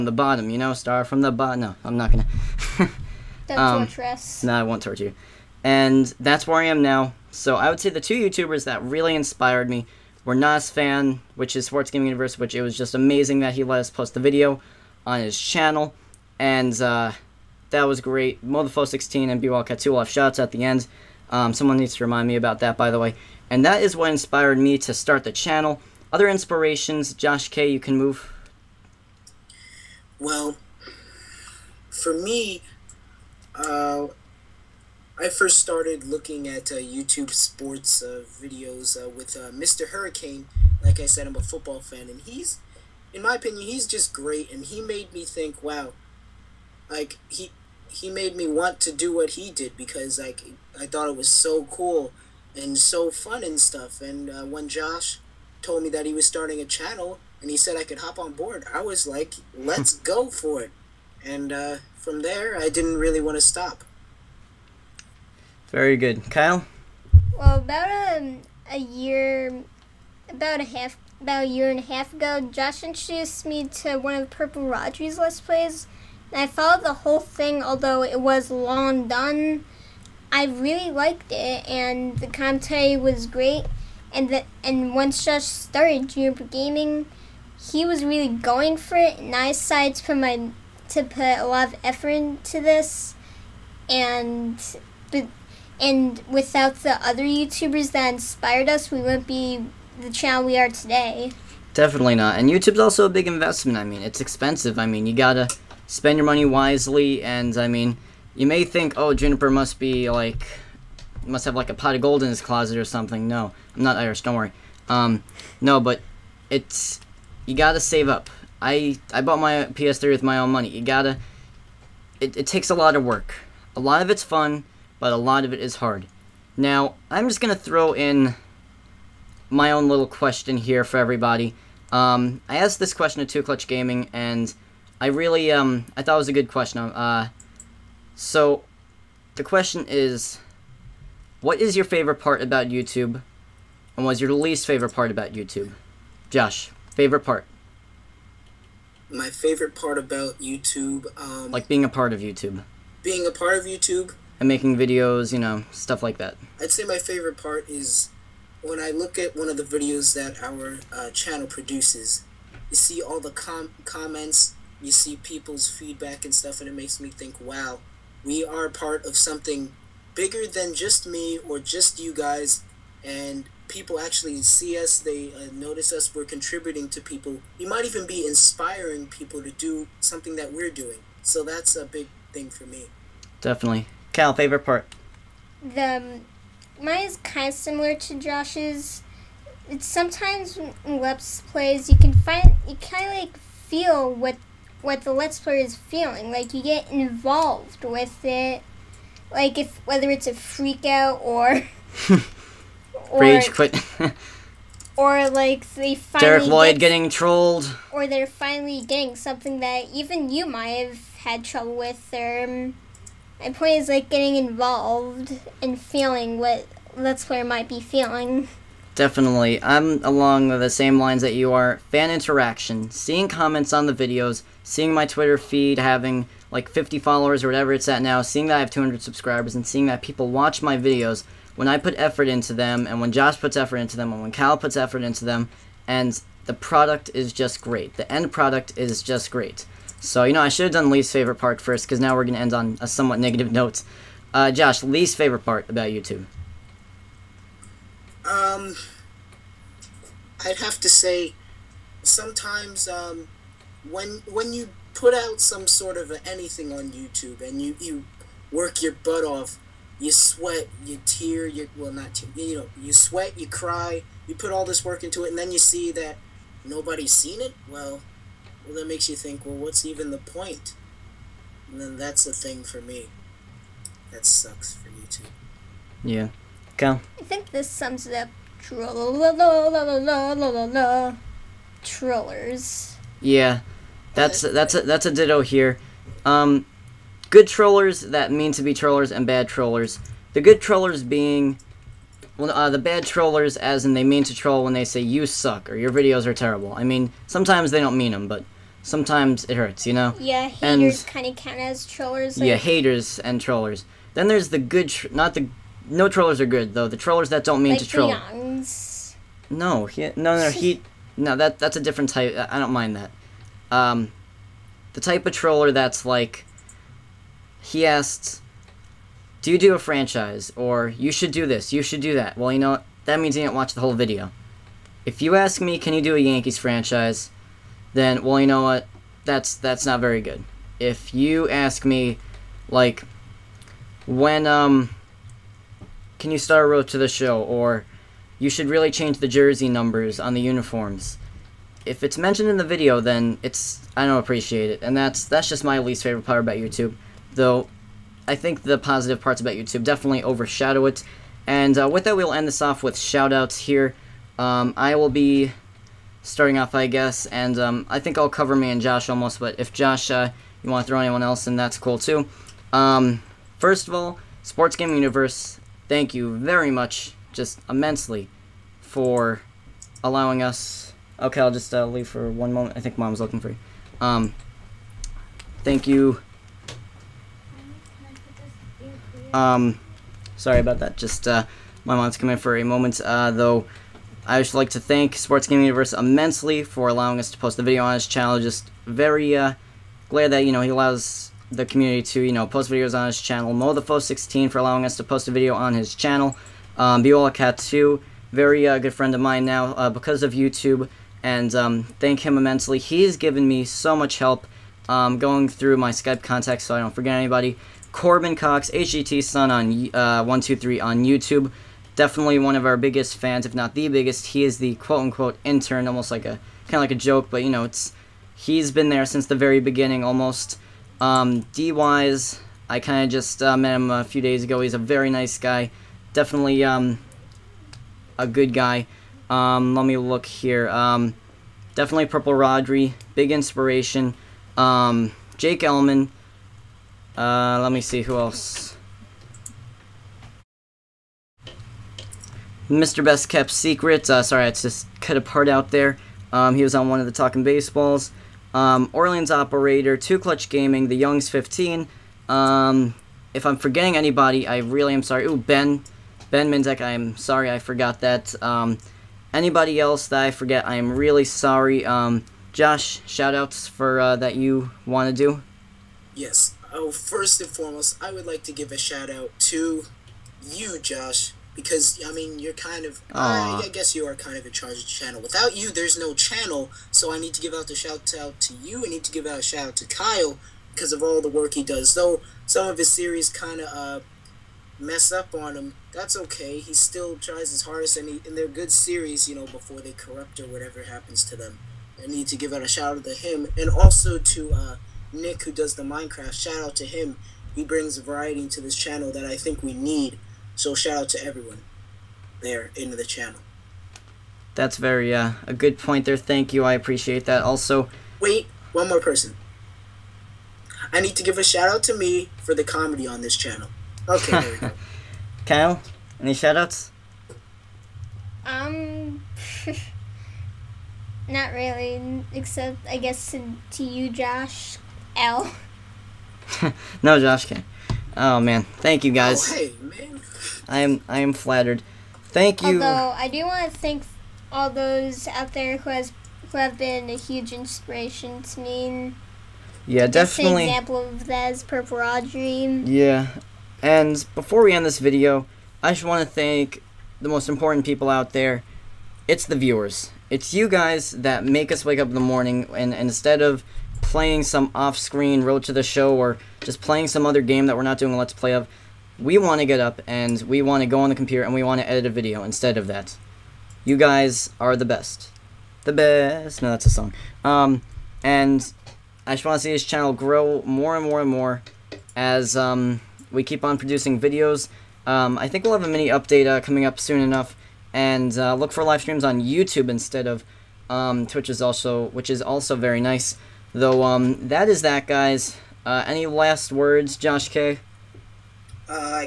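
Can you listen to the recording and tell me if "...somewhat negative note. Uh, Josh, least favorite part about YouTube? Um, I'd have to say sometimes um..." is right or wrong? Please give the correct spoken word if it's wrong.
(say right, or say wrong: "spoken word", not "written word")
right.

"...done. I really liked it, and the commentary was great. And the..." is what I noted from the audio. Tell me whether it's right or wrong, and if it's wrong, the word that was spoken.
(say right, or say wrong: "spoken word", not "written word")
right.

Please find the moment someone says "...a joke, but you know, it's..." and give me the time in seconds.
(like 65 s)
416 s.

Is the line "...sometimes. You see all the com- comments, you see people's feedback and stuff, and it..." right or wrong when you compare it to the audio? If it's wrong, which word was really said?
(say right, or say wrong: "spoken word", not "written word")
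wrong: "produces", not "sometimes".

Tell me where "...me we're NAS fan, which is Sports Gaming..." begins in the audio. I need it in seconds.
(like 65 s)
9 s.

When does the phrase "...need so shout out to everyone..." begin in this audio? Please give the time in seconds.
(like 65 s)
499 s.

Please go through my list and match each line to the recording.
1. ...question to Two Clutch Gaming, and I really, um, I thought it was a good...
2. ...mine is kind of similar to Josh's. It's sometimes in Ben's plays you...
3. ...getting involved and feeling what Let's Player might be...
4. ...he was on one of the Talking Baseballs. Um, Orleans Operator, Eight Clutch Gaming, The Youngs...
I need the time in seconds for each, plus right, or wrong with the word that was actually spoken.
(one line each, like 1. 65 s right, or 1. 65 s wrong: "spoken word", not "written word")
1. 132 s right
2. 186 s wrong: "Let", not "Ben"
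3. 214 s right
4. 446 s wrong: "Two", not "Eight".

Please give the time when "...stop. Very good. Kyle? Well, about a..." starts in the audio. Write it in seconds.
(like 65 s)
63 s.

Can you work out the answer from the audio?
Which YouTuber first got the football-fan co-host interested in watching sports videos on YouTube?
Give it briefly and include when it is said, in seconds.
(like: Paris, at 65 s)
Mr. Hurricane, at 39 s.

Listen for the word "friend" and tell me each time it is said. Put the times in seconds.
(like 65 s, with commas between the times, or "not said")
398 s.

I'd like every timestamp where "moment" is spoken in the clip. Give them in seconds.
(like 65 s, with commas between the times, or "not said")
372 s, 382 s.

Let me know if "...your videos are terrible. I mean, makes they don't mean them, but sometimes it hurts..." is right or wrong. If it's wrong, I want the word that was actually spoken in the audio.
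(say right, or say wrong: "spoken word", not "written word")
wrong: "sometimes", not "makes".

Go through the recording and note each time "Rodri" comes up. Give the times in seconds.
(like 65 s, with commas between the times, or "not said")
74 s, 432 s, 541 s.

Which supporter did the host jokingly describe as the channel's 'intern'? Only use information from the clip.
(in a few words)
Corbin Cox.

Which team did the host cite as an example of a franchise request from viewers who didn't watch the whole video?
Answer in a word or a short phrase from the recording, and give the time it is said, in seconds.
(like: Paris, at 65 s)
Yankees, at 326 s.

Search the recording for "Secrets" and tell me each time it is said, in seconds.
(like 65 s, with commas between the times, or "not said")
443 s.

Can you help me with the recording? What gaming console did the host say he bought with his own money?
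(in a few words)
PS3.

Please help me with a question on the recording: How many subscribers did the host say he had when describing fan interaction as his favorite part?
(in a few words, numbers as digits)
200.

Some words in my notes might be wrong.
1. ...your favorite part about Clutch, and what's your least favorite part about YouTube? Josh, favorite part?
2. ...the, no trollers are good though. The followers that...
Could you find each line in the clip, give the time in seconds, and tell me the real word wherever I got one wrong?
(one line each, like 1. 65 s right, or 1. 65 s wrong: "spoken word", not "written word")
1. 141 s wrong: "YouTube", not "Clutch"
2. 305 s wrong: "trollers", not "followers".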